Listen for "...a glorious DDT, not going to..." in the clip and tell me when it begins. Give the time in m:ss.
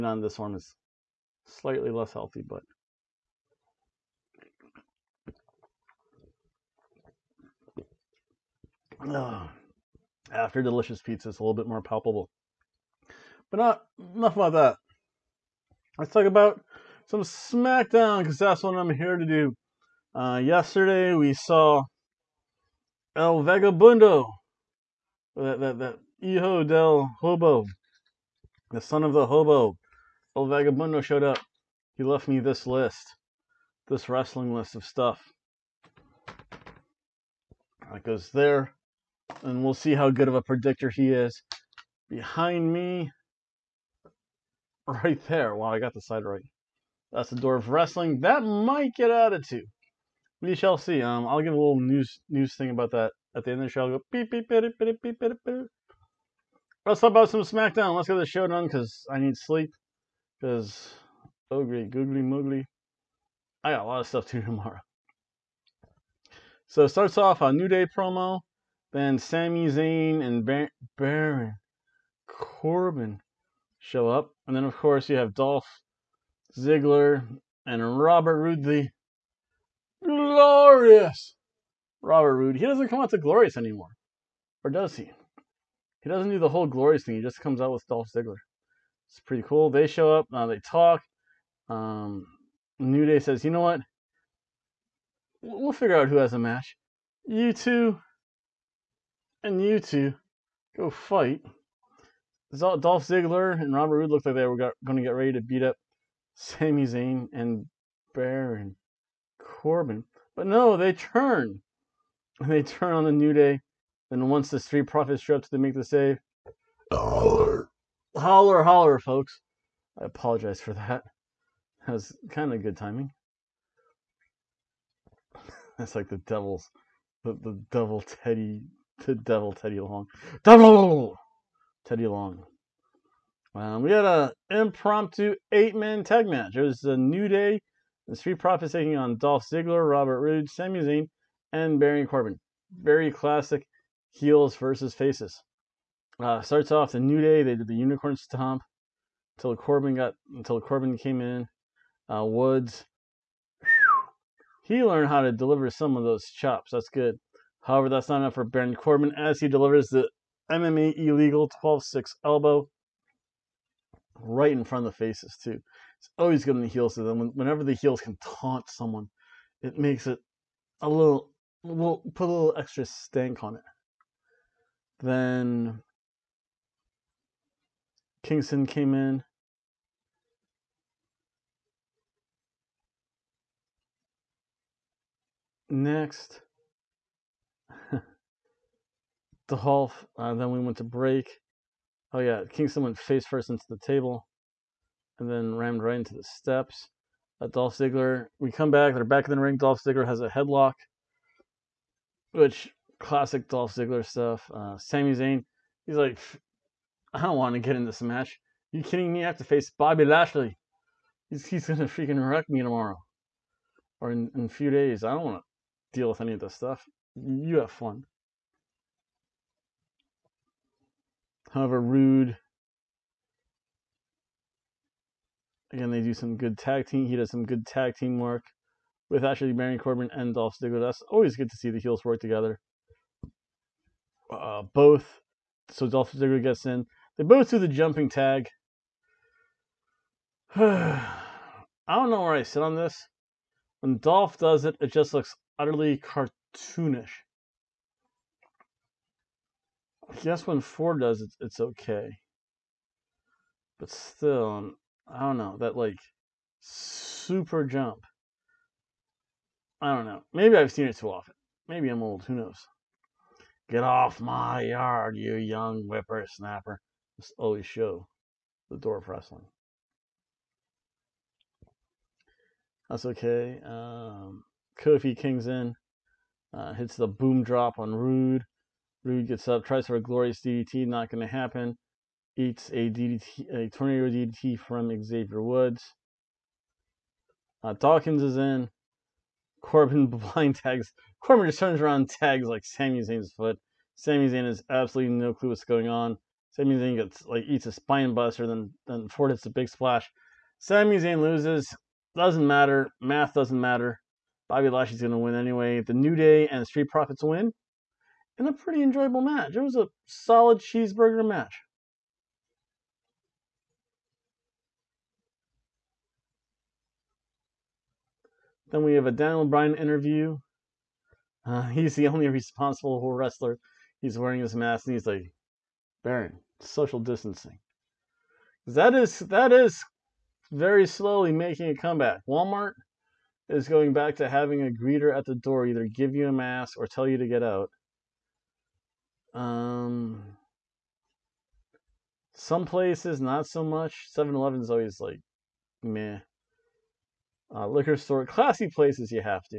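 4:39.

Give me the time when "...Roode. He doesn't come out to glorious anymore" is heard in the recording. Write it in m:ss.
1:22.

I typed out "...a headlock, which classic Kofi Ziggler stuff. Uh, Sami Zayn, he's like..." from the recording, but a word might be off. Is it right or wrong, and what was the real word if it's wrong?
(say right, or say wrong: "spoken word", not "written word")
wrong: "Dolph", not "Kofi".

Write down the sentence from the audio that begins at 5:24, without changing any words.
He's wearing his mask and he's like, Baron, social distancing.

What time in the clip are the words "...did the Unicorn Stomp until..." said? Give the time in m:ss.
2:27.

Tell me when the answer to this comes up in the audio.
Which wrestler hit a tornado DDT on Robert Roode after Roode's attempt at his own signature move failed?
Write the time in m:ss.
4:45.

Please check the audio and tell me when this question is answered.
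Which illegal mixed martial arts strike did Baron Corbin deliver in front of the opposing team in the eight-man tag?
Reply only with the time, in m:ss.
2:41.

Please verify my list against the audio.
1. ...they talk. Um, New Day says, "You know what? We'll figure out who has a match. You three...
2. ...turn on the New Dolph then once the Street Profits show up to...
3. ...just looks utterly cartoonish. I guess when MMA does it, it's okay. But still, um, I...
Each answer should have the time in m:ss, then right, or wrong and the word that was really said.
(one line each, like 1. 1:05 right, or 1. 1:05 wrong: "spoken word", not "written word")
1. 1:30 wrong: "two", not "three"
2. 1:52 wrong: "Day", not "Dolph"
3. 4:04 wrong: "Ford", not "MMA".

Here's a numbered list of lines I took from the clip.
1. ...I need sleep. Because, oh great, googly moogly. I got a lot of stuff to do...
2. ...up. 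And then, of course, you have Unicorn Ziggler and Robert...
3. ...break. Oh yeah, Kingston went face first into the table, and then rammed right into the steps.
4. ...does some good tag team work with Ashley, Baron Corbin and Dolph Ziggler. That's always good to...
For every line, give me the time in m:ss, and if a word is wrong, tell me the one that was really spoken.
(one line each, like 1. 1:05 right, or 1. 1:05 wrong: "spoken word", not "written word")
1. 0:59 right
2. 1:14 wrong: "Dolph", not "Unicorn"
3. 3:10 right
4. 3:47 right.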